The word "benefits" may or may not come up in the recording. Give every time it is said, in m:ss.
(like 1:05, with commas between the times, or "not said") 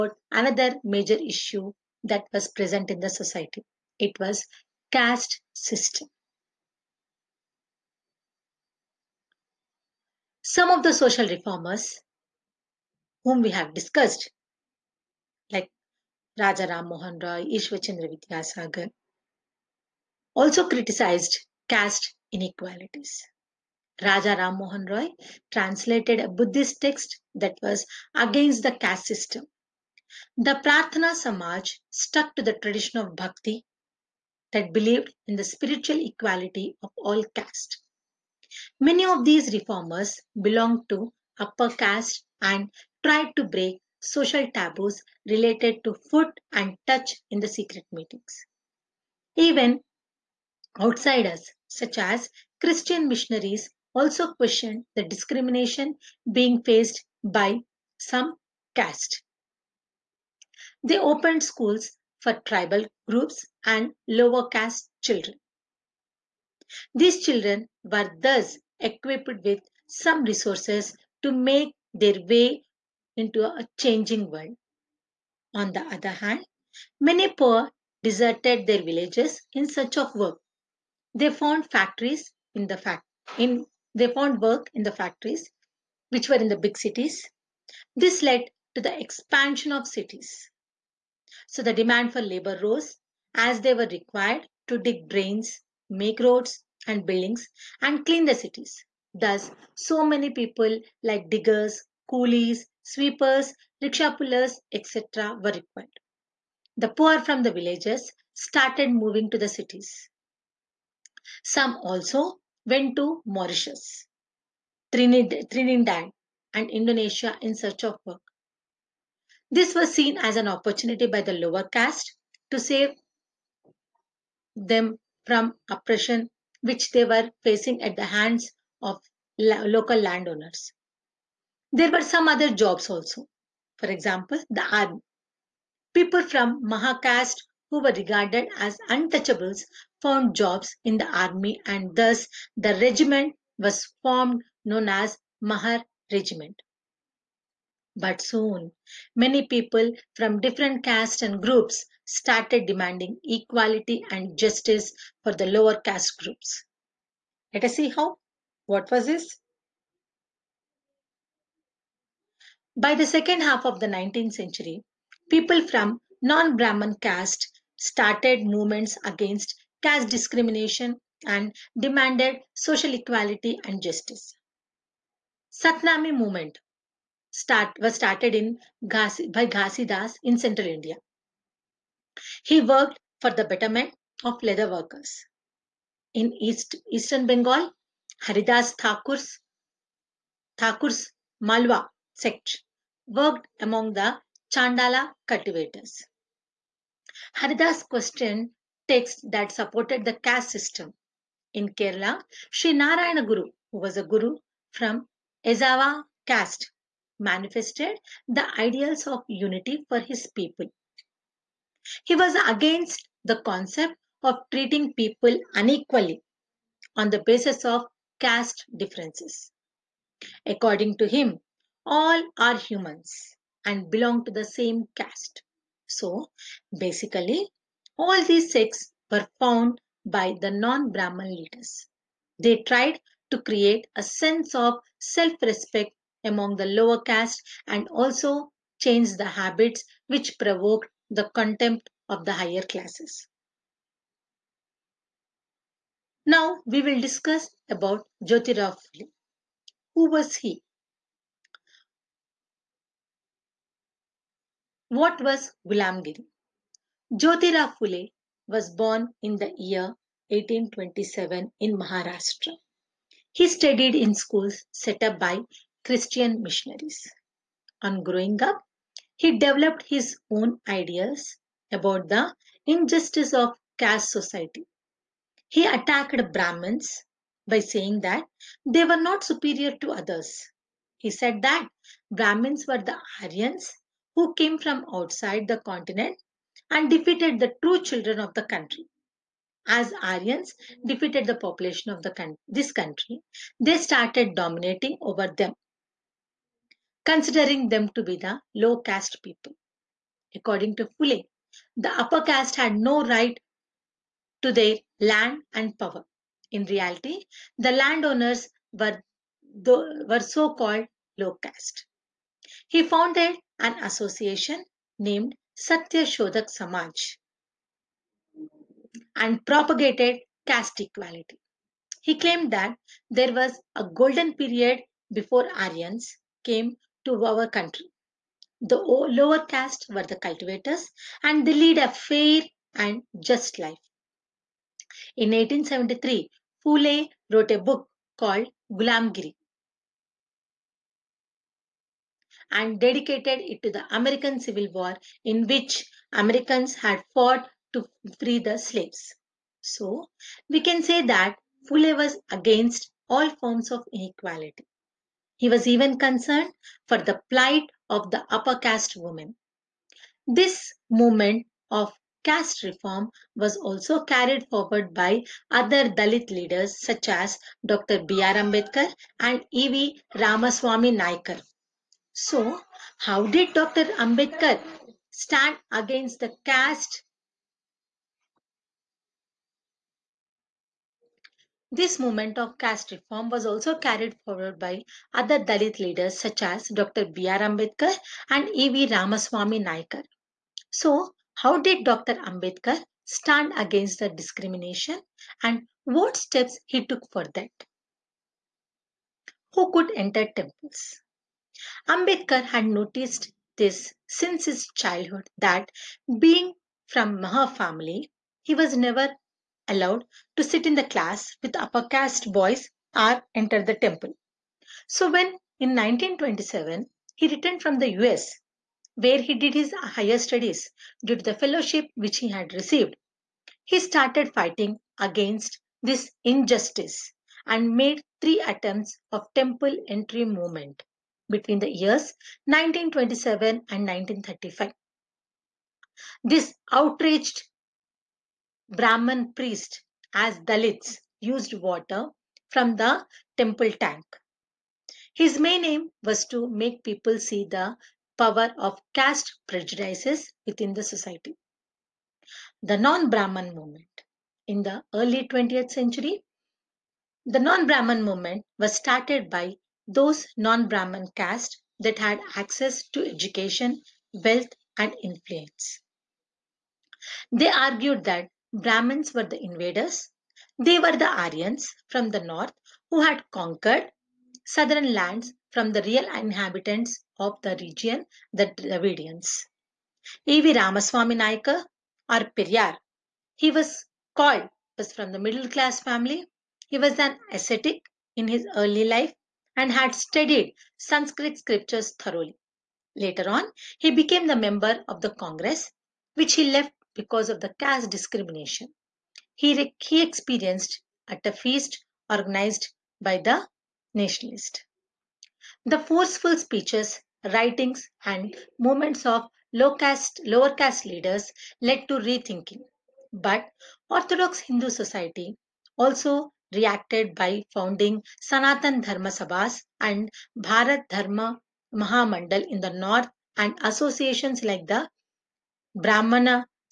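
not said.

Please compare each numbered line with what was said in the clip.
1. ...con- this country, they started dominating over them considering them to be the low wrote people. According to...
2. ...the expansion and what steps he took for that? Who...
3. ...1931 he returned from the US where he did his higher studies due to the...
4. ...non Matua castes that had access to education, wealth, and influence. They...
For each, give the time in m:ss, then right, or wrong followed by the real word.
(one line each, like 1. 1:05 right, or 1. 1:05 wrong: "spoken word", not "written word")
1. 4:52 wrong: "caste", not "wrote"
2. 6:34 wrong: "discrimination", not "expansion"
3. 6:55 wrong: "1927", not "1931"
4. 7:40 wrong: "Brahman", not "Matua".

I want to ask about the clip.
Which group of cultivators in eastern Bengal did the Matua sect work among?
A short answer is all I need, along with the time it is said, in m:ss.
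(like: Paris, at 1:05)
Chandala cultivators, at 3:14.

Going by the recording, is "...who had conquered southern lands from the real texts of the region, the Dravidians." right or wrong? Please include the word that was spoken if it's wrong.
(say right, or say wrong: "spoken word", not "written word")
wrong: "inhabitants", not "texts".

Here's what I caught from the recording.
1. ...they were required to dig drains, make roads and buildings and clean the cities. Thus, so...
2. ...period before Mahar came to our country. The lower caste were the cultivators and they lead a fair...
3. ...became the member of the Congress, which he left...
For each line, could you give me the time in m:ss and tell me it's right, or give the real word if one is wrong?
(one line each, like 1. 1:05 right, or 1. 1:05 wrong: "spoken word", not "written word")
1. 1:33 right
2. 5:24 wrong: "Aryans", not "Mahar"
3. 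8:13 right.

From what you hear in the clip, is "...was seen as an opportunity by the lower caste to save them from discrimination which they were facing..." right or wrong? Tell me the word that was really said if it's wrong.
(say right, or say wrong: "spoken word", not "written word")
wrong: "oppression", not "discrimination".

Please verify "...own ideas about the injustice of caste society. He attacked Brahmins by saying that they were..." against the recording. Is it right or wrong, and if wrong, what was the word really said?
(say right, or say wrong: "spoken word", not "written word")
right.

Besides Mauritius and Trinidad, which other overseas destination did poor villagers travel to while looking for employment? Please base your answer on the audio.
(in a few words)
Indonesia.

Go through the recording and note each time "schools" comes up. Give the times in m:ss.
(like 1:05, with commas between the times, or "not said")
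1:01, 4:24.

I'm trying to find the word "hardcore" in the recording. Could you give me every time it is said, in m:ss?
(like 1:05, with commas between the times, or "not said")
not said.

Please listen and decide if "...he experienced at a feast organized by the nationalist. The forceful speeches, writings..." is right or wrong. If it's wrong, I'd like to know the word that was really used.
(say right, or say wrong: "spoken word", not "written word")
right.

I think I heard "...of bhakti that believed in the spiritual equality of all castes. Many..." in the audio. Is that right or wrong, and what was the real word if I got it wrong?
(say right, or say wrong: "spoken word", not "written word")
right.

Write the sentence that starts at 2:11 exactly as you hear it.
There were some other jobs also.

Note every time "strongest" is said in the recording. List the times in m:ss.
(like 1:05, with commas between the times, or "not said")
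not said.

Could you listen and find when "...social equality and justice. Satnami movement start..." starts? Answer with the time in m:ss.
2:52.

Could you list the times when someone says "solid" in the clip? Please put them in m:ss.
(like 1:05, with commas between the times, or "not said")
not said.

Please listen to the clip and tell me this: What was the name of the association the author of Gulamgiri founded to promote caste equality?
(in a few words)
Satya Shodak Samaj.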